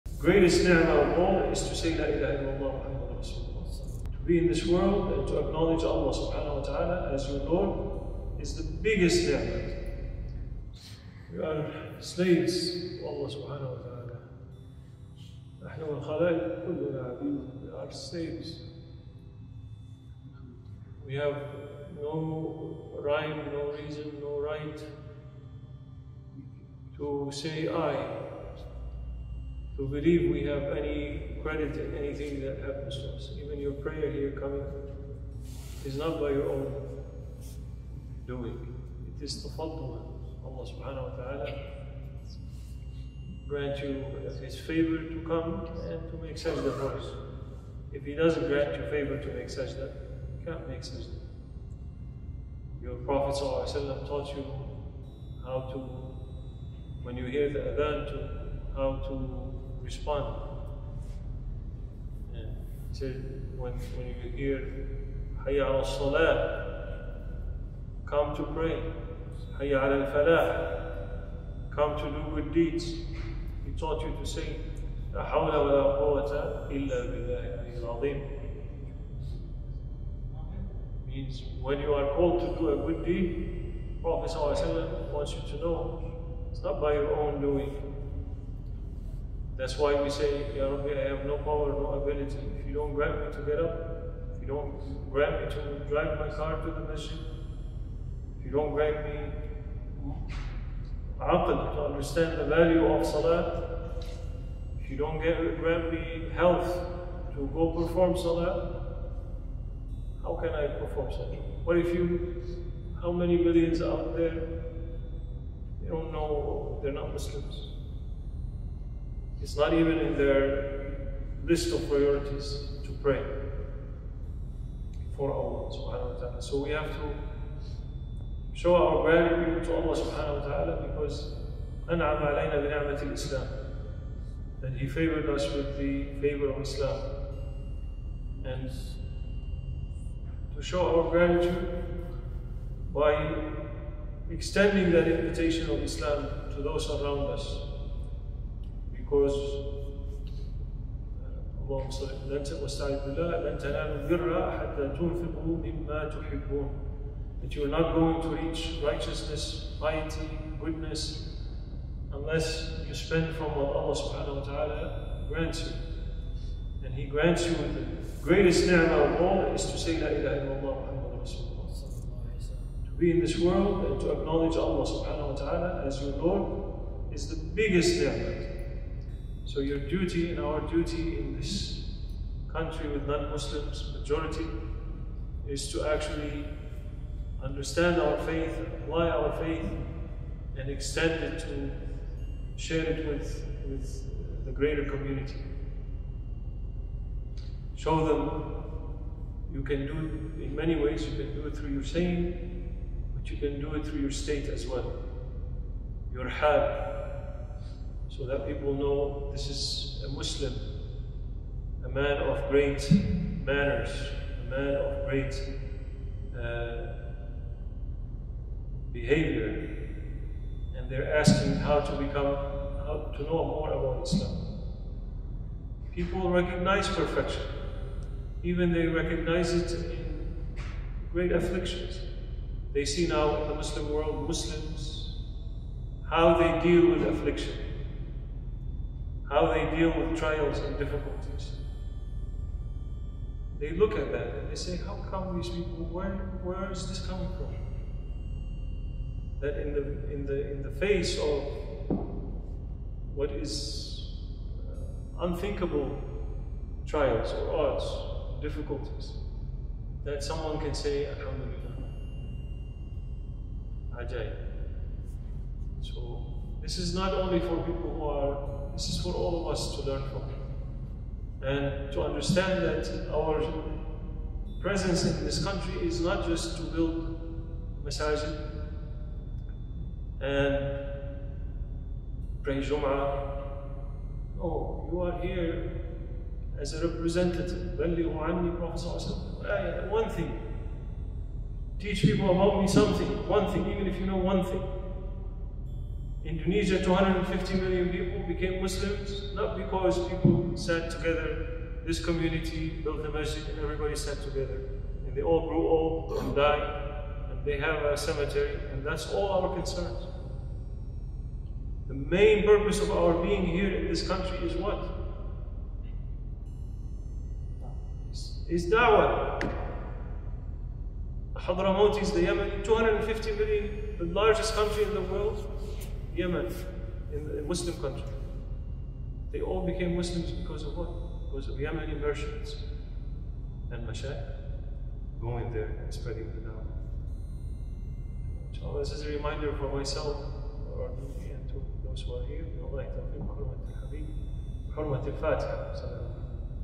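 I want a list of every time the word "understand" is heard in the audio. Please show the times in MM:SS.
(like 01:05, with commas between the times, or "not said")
01:41, 03:07, 04:32.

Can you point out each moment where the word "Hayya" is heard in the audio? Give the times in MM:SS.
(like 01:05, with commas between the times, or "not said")
01:05, 01:09.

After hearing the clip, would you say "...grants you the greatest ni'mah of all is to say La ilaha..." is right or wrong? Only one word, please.
right.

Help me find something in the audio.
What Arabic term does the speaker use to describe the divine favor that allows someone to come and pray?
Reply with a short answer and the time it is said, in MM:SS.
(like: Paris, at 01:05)
Tafaddul, at 00:39.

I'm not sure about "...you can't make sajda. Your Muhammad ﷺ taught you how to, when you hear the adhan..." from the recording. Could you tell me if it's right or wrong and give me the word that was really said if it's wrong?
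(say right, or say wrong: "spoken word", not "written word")
wrong: "Prophet", not "Muhammad".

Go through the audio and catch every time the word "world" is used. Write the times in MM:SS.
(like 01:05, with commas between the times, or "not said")
00:04, 02:53, 03:53, 05:25.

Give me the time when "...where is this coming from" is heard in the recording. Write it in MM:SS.
04:06.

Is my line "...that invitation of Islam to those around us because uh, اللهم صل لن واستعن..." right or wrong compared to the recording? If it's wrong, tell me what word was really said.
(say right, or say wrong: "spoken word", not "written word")
right.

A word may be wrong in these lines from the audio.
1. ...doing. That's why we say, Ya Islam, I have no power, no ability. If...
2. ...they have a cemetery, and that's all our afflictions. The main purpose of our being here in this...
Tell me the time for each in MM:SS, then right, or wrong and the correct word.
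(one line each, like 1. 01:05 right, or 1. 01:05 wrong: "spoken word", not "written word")
1. 01:27 wrong: "Rabbi", not "Islam"
2. 05:07 wrong: "concerns", not "afflictions".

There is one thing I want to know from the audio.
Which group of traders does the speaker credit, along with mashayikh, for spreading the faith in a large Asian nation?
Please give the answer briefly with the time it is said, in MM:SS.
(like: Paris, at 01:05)
Yemeni merchants, at 05:31.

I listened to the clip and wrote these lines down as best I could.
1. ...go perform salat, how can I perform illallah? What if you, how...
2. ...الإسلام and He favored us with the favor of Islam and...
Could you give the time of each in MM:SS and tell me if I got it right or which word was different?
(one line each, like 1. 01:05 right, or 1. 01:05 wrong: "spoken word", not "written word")
1. 01:47 wrong: "salah", not "illallah"
2. 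02:13 right.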